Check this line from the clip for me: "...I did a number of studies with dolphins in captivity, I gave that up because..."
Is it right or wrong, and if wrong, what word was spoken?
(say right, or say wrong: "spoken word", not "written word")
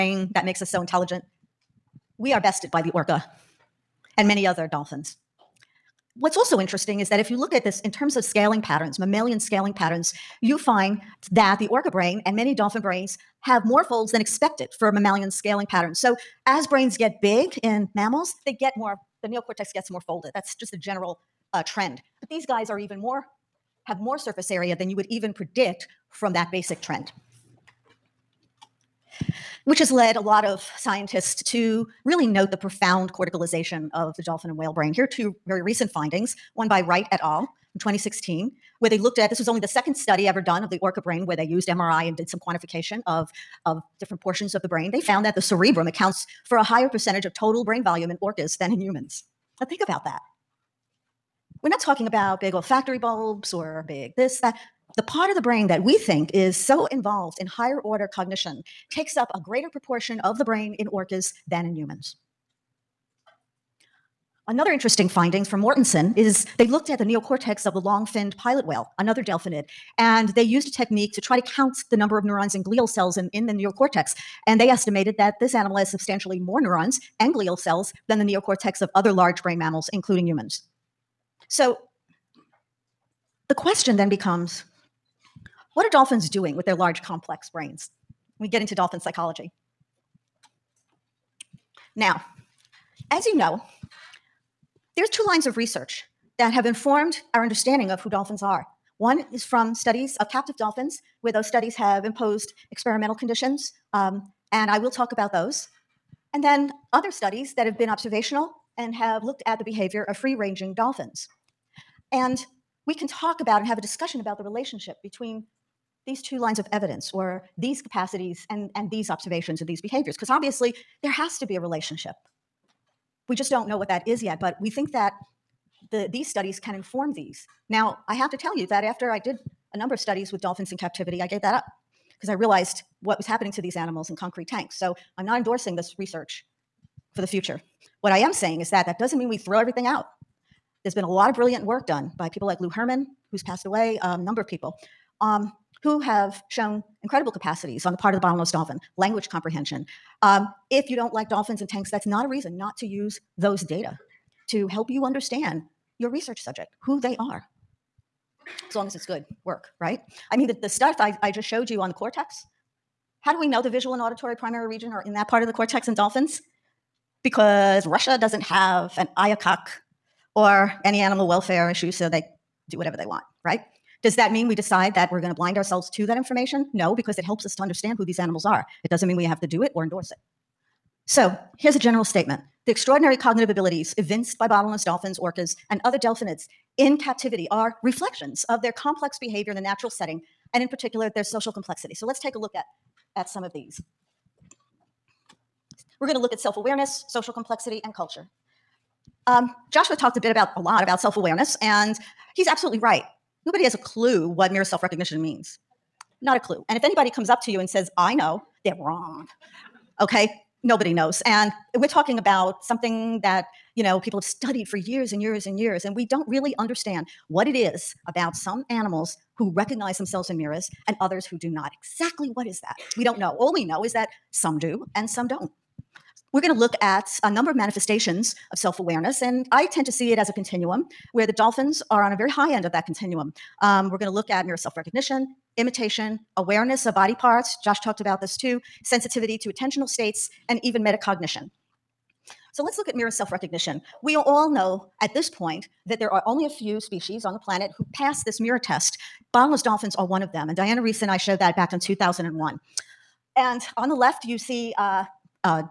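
right.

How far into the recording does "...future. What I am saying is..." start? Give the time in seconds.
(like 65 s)
137 s.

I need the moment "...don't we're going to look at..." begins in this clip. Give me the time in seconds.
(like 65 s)
225 s.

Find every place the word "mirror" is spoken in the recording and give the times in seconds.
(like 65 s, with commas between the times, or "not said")
204 s, 220 s, 234 s, 242 s, 248 s.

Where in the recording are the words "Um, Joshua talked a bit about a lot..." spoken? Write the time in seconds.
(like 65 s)
199 s.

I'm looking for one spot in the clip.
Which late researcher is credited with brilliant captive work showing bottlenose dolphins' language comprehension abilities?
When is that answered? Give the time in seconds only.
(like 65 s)
142 s.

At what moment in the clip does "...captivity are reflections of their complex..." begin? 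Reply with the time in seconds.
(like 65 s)
186 s.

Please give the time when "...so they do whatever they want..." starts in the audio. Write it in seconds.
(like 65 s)
171 s.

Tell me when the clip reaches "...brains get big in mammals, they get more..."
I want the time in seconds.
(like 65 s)
16 s.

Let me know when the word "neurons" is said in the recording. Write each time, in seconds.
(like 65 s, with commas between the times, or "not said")
72 s, 76 s.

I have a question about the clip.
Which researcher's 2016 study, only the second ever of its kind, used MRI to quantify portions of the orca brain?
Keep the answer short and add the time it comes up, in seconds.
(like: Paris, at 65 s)
Wright, at 36 s.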